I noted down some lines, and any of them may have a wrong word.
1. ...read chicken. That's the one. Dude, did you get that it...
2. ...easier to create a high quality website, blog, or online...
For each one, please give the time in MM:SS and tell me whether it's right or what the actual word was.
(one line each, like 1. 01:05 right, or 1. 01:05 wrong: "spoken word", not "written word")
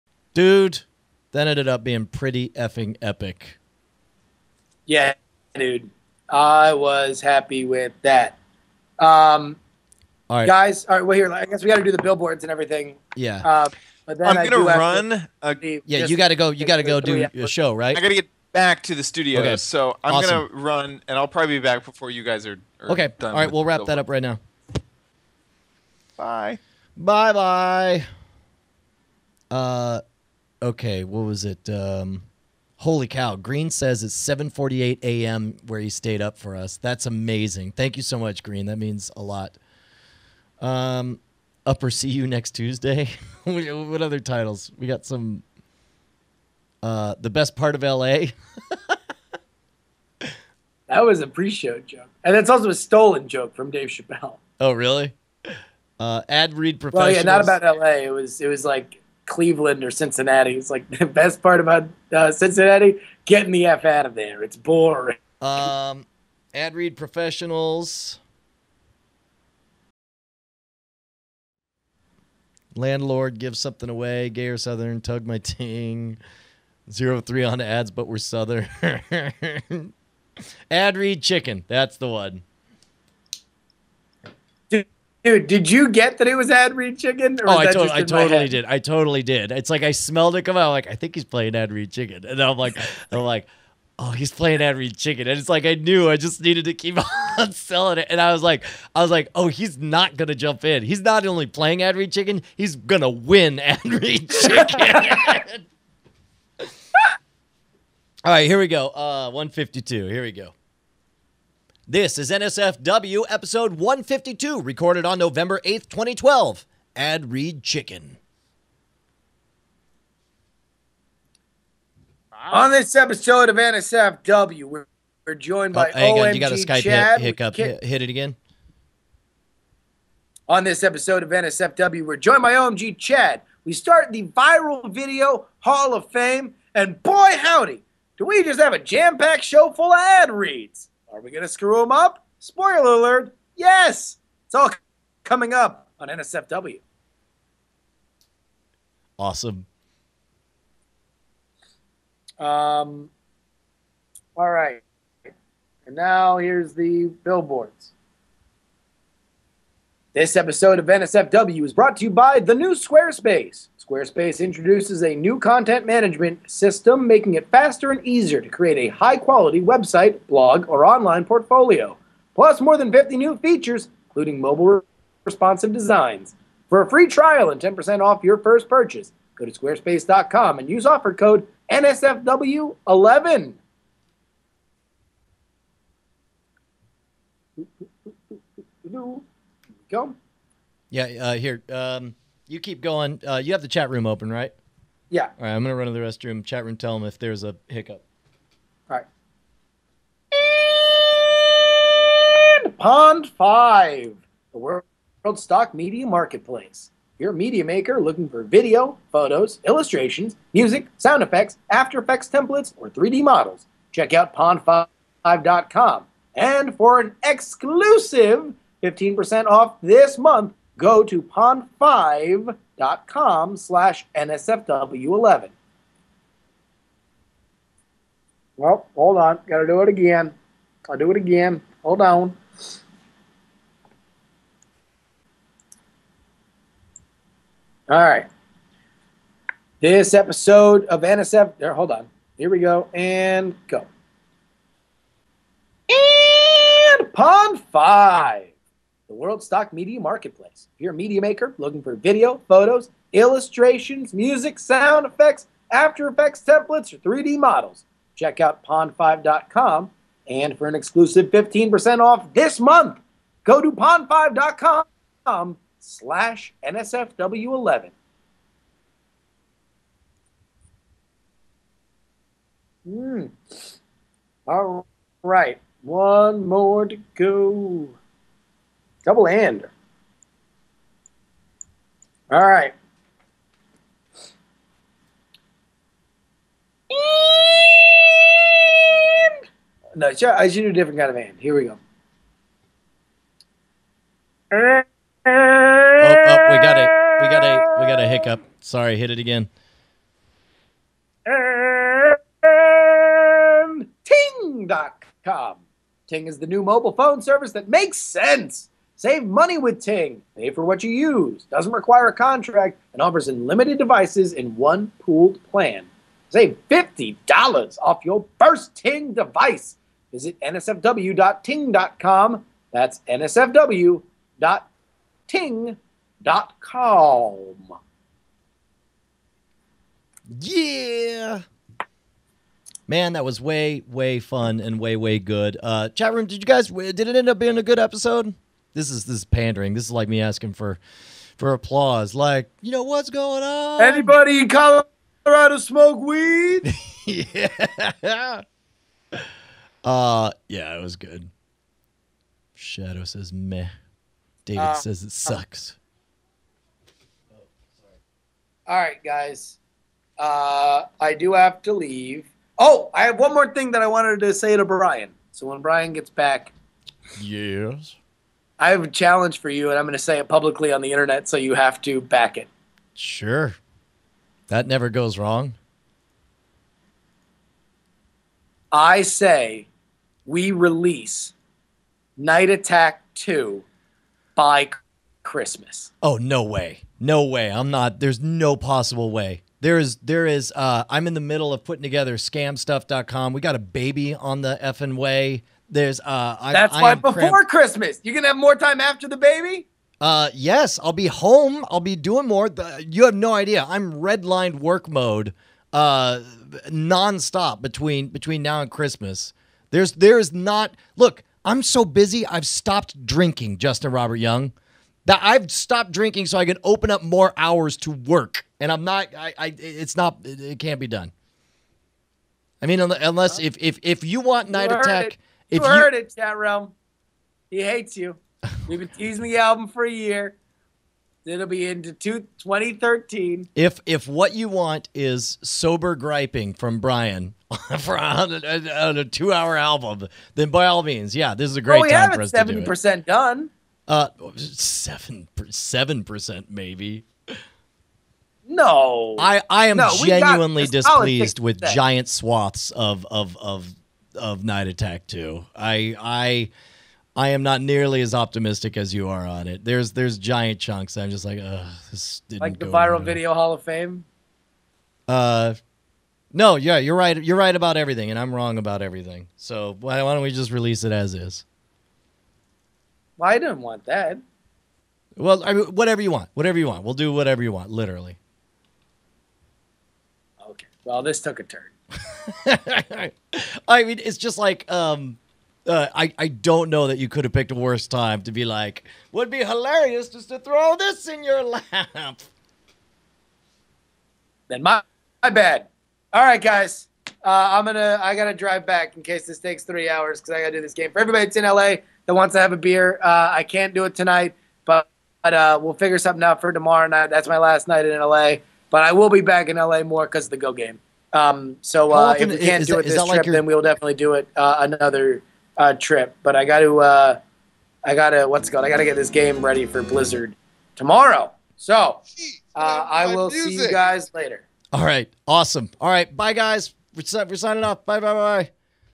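1. 01:20 right
2. 02:48 right.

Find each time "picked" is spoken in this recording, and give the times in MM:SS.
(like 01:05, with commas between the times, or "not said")
08:07.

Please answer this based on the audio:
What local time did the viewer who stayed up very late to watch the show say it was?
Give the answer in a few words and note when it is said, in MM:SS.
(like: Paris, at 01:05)
7:48 a.m., at 00:34.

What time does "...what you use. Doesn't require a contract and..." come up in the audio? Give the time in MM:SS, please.
05:10.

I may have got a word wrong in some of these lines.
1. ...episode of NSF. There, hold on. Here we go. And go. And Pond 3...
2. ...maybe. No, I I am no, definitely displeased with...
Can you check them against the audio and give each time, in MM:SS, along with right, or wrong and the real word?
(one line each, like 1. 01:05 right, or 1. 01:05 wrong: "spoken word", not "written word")
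1. 04:00 wrong: "5", not "3"
2. 07:26 wrong: "genuinely", not "definitely".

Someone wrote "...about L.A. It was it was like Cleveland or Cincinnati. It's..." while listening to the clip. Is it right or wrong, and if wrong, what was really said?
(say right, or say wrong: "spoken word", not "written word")
right.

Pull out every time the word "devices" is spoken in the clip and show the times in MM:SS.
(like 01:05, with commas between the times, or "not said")
05:13, 05:19.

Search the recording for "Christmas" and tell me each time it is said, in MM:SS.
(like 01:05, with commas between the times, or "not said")
06:25, 06:37, 06:48.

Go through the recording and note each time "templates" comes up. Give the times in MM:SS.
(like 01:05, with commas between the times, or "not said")
03:32, 04:16.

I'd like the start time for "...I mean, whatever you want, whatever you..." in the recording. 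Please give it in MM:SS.
07:55.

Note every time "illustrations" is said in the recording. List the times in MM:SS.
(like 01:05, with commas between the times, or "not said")
03:29, 04:13.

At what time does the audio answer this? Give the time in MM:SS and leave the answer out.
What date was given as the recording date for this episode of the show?
01:55.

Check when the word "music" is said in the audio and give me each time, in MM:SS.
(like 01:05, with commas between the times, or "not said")
03:30, 04:14, 08:43.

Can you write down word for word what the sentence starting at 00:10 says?
Guys, all right, well, here, I guess we got to do the billboards and everything.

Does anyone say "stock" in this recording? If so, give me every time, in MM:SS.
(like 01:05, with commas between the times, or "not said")
03:25, 04:09.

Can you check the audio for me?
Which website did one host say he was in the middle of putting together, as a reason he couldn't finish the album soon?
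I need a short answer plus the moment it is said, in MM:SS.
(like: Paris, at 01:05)
scamstuff.com, at 06:32.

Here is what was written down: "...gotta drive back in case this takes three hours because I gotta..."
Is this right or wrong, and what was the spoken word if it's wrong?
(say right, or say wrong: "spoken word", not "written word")
right.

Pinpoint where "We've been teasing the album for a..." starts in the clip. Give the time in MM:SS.
07:08.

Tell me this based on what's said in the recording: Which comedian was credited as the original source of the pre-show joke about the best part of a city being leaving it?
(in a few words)
Dave Chappelle.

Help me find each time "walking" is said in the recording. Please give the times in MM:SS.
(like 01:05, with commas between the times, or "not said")
not said.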